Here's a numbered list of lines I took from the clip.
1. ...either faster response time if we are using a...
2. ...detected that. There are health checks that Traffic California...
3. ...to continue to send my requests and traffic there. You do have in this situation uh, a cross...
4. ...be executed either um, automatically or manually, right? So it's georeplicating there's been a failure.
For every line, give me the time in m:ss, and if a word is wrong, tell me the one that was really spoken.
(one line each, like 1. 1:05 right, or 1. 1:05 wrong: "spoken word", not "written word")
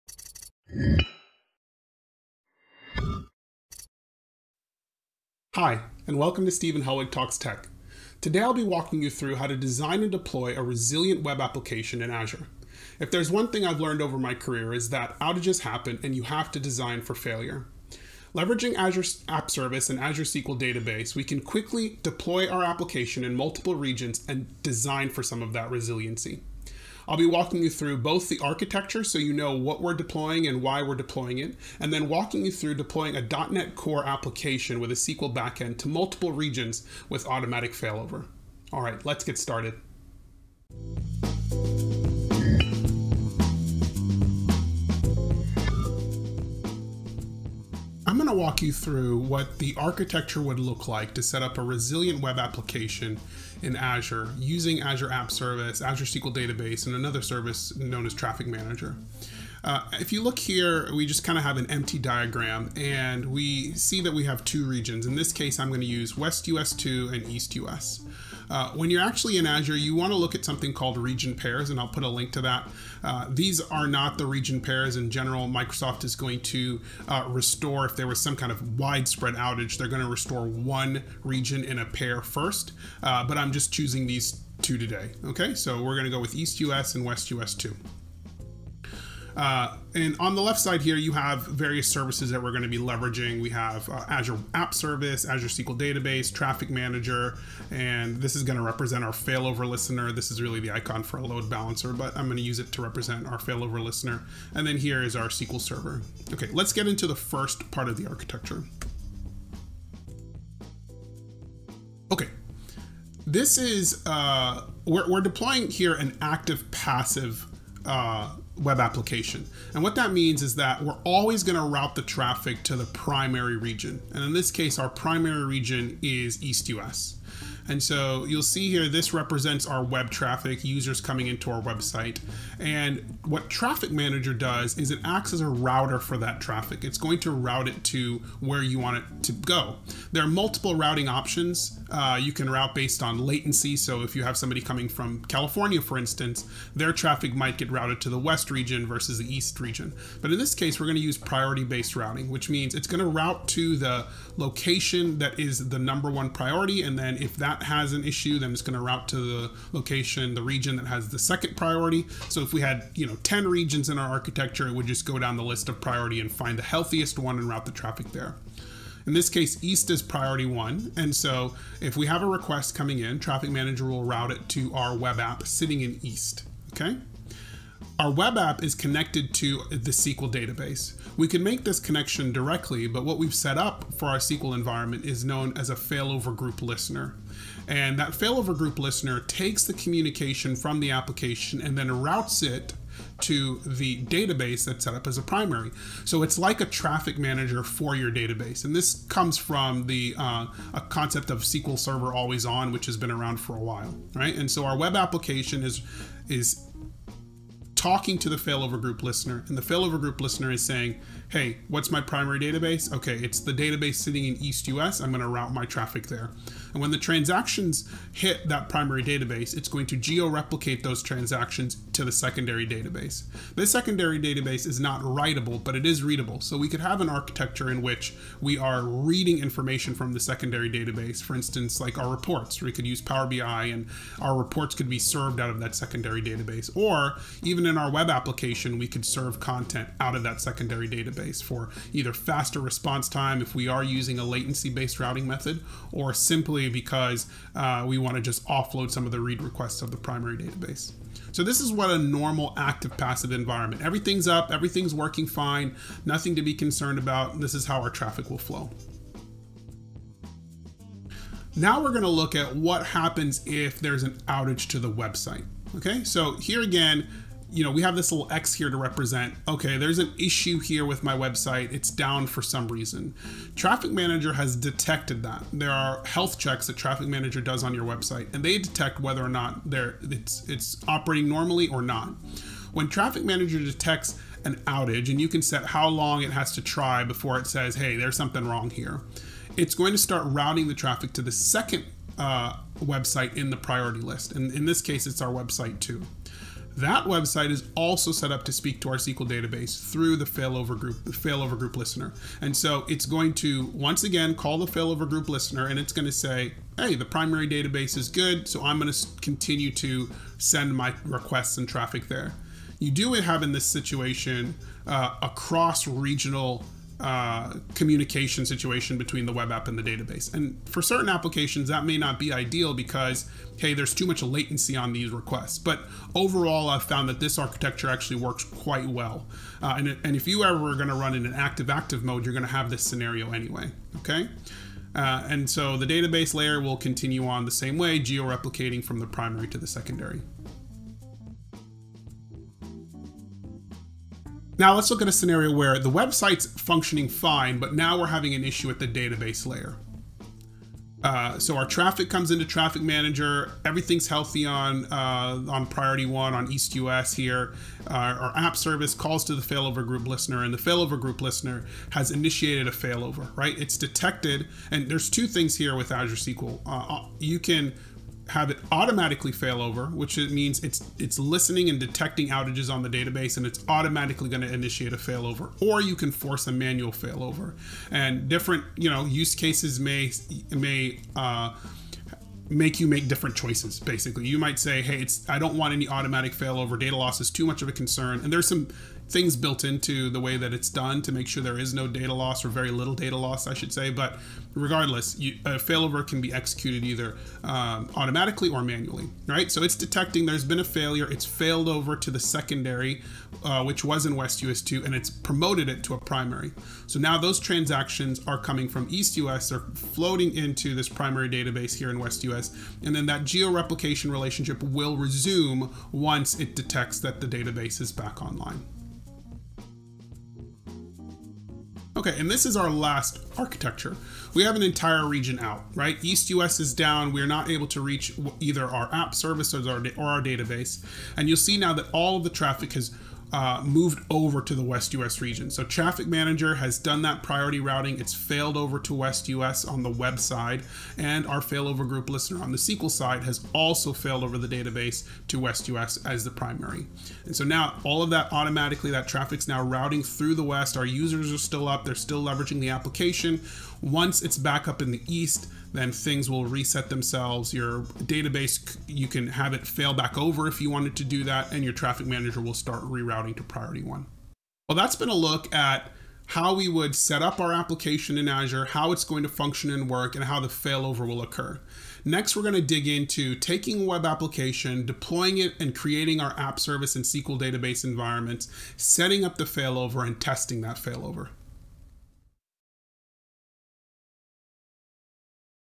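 1. 4:01 right
2. 4:34 wrong: "Manager", not "California"
3. 5:08 right
4. 6:36 wrong: "detecting", not "georeplicating".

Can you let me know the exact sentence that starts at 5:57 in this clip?
Uh, our app service calls to the failover group listener, and the failover group listener has initiated a failover.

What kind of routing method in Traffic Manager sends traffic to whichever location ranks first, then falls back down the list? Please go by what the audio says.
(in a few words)
priority based routing.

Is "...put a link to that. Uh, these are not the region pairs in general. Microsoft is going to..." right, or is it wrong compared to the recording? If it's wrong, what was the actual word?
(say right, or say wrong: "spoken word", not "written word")
right.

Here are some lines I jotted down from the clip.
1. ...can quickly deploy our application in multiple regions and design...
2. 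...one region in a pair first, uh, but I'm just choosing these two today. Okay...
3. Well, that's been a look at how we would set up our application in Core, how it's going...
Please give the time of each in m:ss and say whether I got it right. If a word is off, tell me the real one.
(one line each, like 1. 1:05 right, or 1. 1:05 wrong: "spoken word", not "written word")
1. 0:21 right
2. 1:20 right
3. 7:44 wrong: "Azure", not "Core".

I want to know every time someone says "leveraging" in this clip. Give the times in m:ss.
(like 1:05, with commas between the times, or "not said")
0:18, 1:32, 7:32.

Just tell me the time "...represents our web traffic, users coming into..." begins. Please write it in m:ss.
2:09.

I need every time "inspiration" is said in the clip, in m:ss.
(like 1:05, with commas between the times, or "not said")
not said.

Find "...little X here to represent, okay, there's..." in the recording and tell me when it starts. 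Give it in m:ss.
4:28.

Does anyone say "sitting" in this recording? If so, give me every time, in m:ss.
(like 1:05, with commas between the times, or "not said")
2:55, 3:33.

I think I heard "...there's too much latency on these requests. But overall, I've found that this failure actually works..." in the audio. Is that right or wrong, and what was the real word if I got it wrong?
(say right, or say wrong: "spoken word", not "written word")
wrong: "architecture", not "failure".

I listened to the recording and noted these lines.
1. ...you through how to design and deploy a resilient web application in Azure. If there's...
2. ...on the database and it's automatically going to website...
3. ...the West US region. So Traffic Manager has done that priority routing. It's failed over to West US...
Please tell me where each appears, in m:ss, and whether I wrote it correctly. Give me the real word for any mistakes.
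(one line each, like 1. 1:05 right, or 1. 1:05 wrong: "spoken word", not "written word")
1. 0:09 right
2. 6:12 wrong: "initiate", not "website"
3. 7:14 right.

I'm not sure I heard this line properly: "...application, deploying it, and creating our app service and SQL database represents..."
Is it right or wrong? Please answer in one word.
wrong.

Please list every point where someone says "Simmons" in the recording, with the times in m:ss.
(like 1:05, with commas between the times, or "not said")
not said.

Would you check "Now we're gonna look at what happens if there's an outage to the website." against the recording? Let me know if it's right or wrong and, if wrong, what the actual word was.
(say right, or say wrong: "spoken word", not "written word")
right.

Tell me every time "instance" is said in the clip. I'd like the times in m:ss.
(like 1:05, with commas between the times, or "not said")
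2:25, 3:51.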